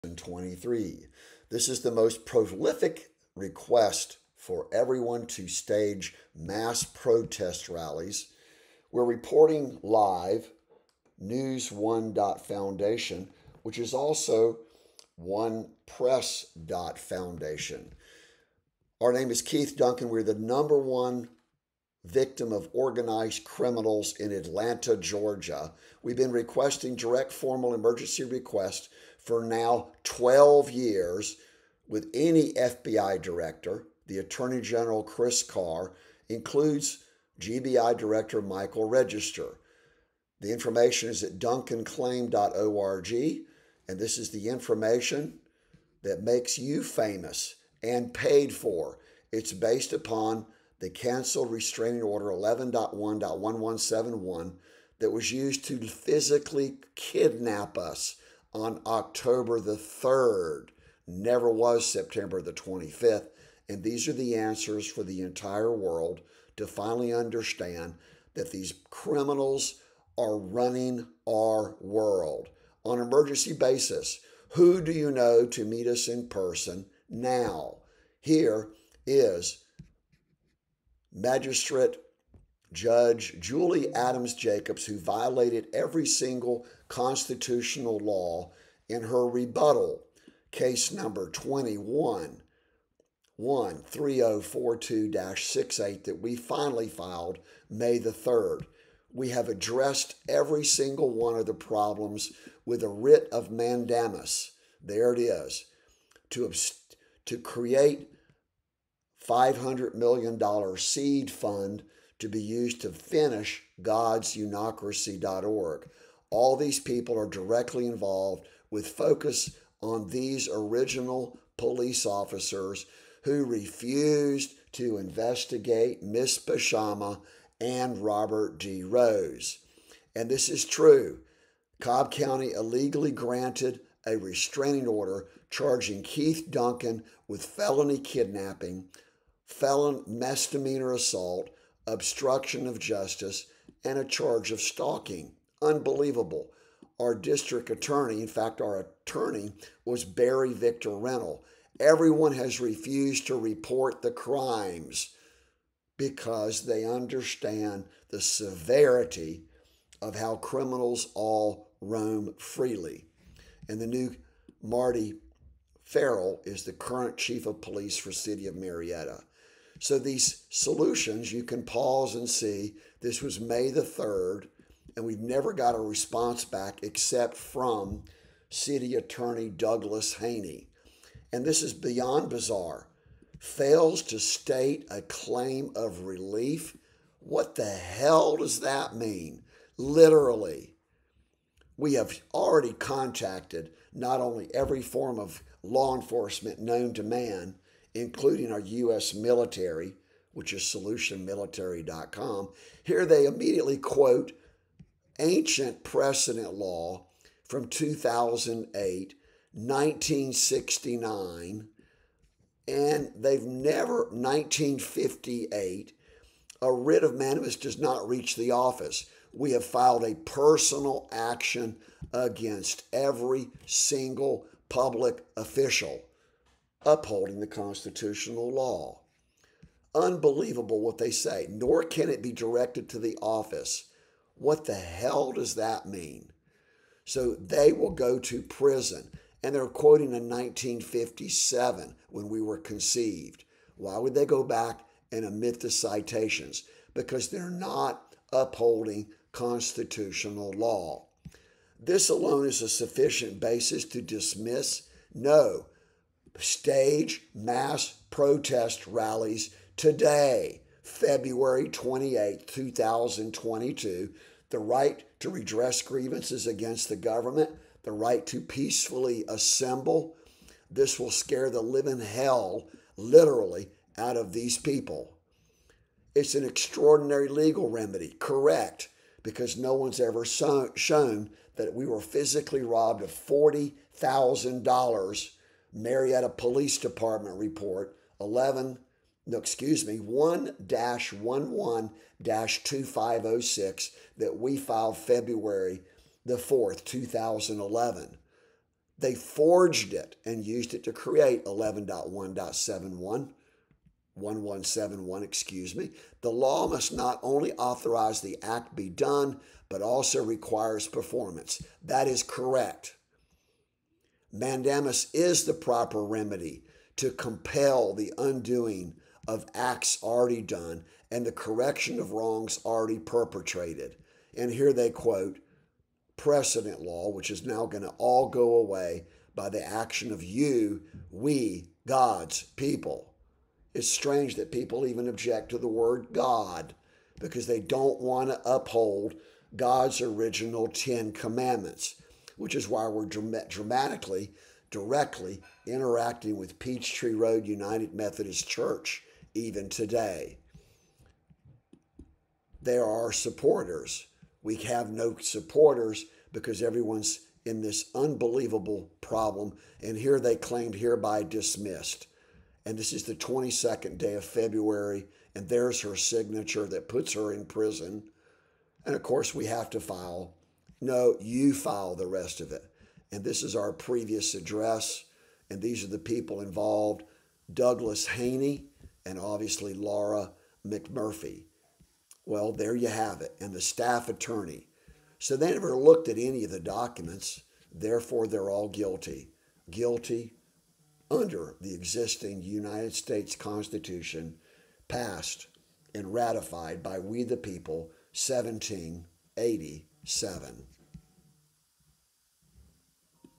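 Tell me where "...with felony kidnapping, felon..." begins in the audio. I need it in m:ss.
2:17.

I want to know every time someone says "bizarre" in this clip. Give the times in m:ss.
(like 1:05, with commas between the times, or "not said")
3:02.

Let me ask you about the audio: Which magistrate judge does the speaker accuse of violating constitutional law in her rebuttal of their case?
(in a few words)
Julie Adams Jacobs.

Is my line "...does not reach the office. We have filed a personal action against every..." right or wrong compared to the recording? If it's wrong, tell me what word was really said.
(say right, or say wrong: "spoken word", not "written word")
right.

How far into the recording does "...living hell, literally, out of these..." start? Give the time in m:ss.
4:31.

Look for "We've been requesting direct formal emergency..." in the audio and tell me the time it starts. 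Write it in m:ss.
0:26.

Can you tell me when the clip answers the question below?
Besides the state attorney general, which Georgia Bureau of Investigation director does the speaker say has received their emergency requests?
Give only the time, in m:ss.
0:38.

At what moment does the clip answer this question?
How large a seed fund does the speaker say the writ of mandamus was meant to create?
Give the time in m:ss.
1:49.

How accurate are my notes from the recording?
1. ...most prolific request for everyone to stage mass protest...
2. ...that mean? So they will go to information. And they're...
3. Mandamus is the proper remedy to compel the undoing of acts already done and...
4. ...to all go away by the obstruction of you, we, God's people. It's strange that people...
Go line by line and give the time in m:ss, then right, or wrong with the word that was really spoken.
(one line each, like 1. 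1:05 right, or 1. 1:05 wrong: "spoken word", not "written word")
1. 0:01 right
2. 3:55 wrong: "prison", not "information"
3. 5:14 right
4. 5:27 wrong: "action", not "obstruction".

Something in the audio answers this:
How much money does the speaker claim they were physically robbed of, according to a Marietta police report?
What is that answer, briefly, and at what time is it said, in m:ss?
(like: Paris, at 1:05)
$40,000, at 4:43.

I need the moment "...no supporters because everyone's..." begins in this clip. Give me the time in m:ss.
5:54.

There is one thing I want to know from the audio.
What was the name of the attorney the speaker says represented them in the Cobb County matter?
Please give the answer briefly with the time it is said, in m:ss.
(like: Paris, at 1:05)
Barry Victor Rennell, at 2:30.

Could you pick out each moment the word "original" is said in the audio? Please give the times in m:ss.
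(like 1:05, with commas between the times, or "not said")
2:00, 5:40.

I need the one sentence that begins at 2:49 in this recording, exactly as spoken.
So these solutions you can pause and see.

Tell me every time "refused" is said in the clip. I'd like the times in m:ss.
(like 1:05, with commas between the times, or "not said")
2:03, 2:32.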